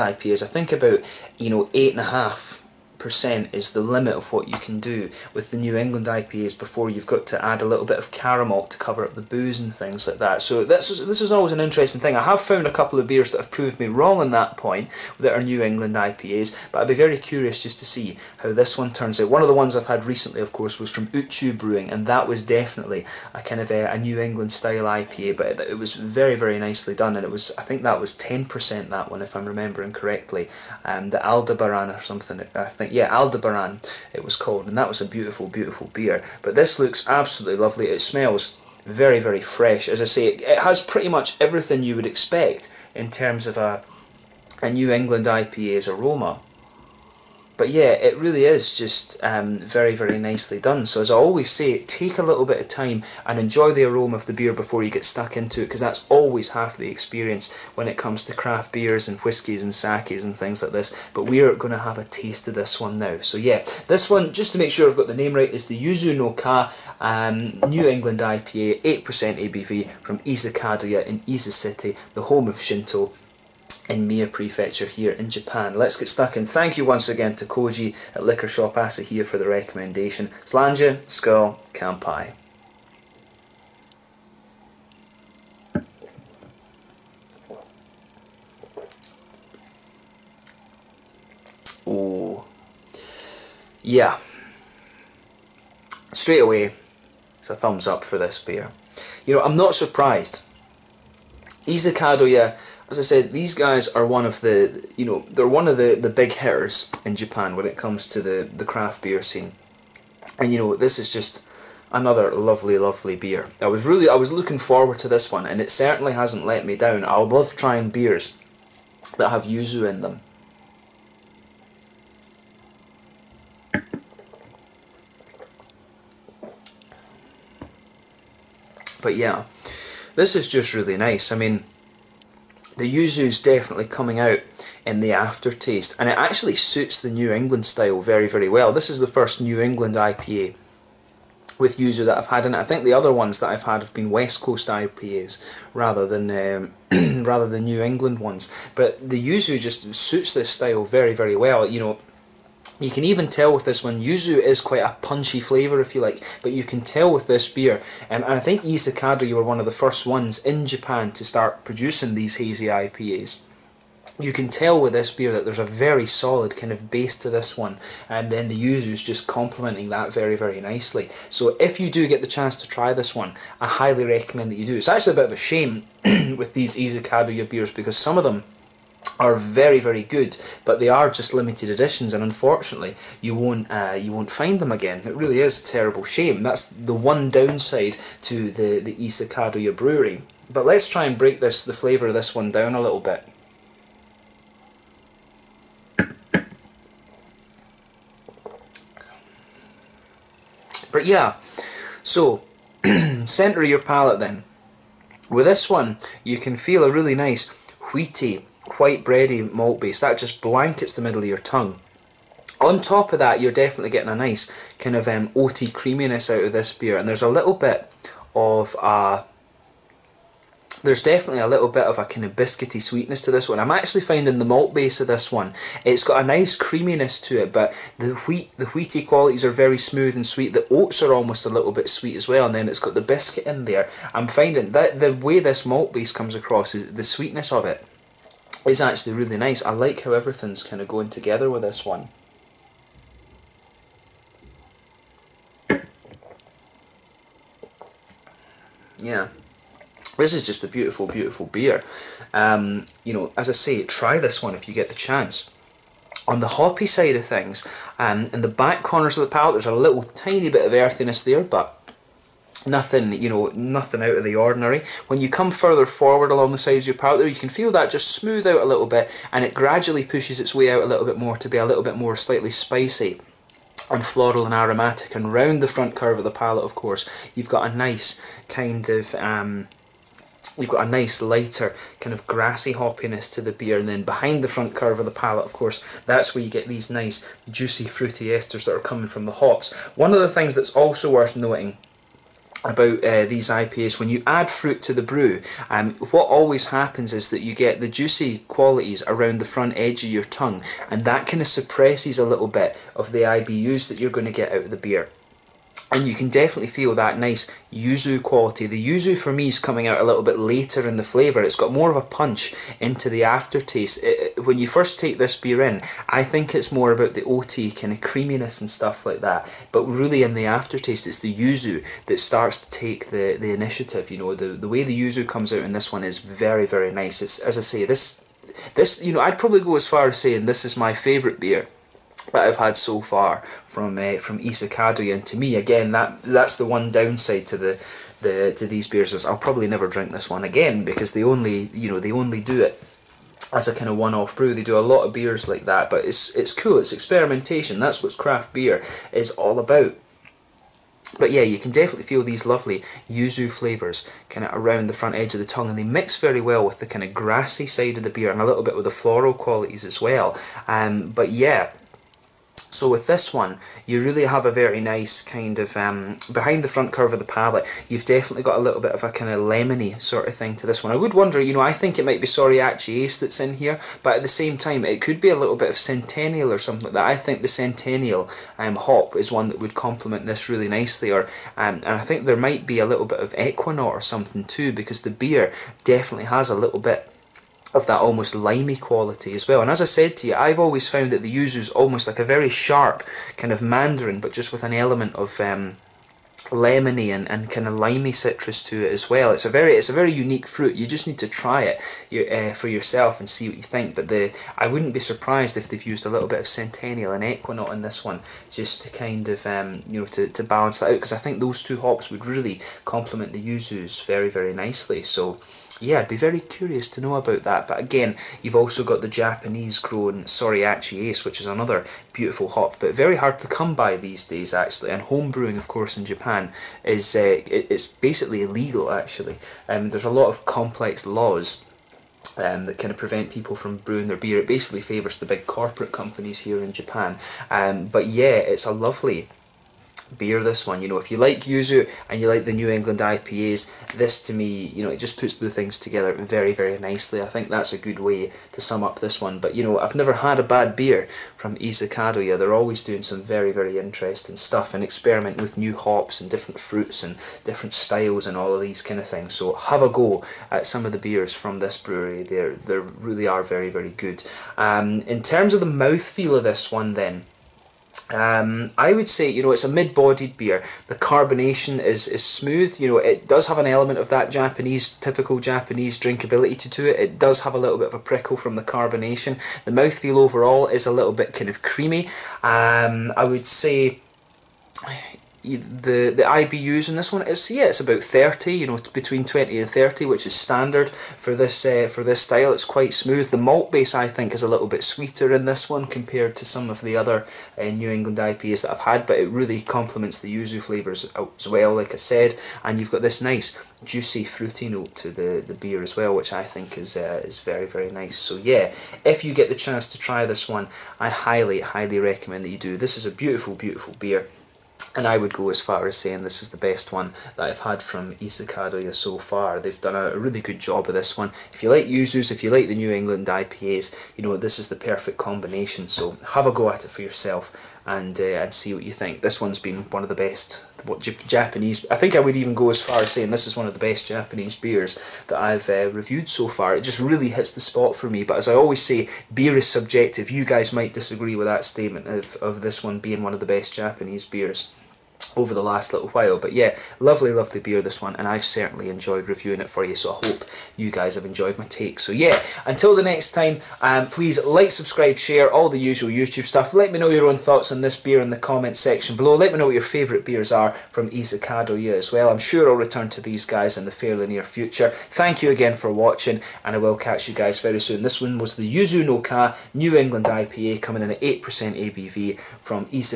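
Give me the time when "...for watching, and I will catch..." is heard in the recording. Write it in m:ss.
9:25.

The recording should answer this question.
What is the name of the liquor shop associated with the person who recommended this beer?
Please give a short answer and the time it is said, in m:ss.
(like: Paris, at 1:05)
Liquor Shop Asahiya, at 1:18.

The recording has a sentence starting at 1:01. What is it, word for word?
But we are going to have a taste of this one now.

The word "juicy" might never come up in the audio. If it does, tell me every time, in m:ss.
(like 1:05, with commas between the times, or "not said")
4:47, 4:57, 8:23.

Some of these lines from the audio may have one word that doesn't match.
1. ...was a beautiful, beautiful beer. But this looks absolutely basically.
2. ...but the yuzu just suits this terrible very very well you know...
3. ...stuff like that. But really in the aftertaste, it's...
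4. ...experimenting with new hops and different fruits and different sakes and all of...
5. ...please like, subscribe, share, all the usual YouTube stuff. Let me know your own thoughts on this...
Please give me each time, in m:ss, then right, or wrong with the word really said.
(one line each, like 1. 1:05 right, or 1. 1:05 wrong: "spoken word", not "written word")
1. 0:34 wrong: "lovely", not "basically"
2. 2:28 wrong: "style", not "terrible"
3. 5:18 right
4. 7:34 wrong: "styles", not "sakes"
5. 9:14 right.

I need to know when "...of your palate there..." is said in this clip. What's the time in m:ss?
4:26.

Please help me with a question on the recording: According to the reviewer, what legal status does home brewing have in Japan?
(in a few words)
basically illegal.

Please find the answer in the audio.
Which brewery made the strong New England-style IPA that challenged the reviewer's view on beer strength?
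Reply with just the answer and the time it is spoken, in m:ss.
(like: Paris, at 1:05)
Uchu Brewing, at 0:21.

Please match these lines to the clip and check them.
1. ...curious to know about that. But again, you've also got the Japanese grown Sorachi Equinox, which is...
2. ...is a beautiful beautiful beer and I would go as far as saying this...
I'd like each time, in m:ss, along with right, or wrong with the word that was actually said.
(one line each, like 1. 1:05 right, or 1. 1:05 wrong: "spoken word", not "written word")
1. 6:56 wrong: "Ace", not "Equinox"
2. 8:32 right.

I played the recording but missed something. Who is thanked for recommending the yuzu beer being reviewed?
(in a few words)
Koji.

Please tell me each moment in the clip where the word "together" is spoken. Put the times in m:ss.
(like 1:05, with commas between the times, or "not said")
4:01, 7:25.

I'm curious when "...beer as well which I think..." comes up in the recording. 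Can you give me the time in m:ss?
8:25.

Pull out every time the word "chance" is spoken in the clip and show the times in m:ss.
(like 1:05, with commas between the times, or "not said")
2:52, 4:14, 8:29.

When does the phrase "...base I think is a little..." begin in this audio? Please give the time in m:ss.
8:13.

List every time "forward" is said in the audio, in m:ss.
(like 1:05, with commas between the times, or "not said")
1:54, 4:25.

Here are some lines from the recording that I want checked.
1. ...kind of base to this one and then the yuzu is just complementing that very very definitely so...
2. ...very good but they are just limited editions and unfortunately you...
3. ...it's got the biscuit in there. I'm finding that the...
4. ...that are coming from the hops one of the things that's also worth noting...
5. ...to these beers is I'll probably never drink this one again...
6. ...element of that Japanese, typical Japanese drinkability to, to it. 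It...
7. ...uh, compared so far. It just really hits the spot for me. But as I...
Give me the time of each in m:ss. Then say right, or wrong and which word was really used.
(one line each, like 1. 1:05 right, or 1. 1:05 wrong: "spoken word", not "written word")
1. 2:46 wrong: "nicely", not "definitely"
2. 2:59 right
3. 3:52 right
4. 4:48 right
5. 5:38 right
6. 7:53 right
7. 8:55 wrong: "reviewed", not "compared".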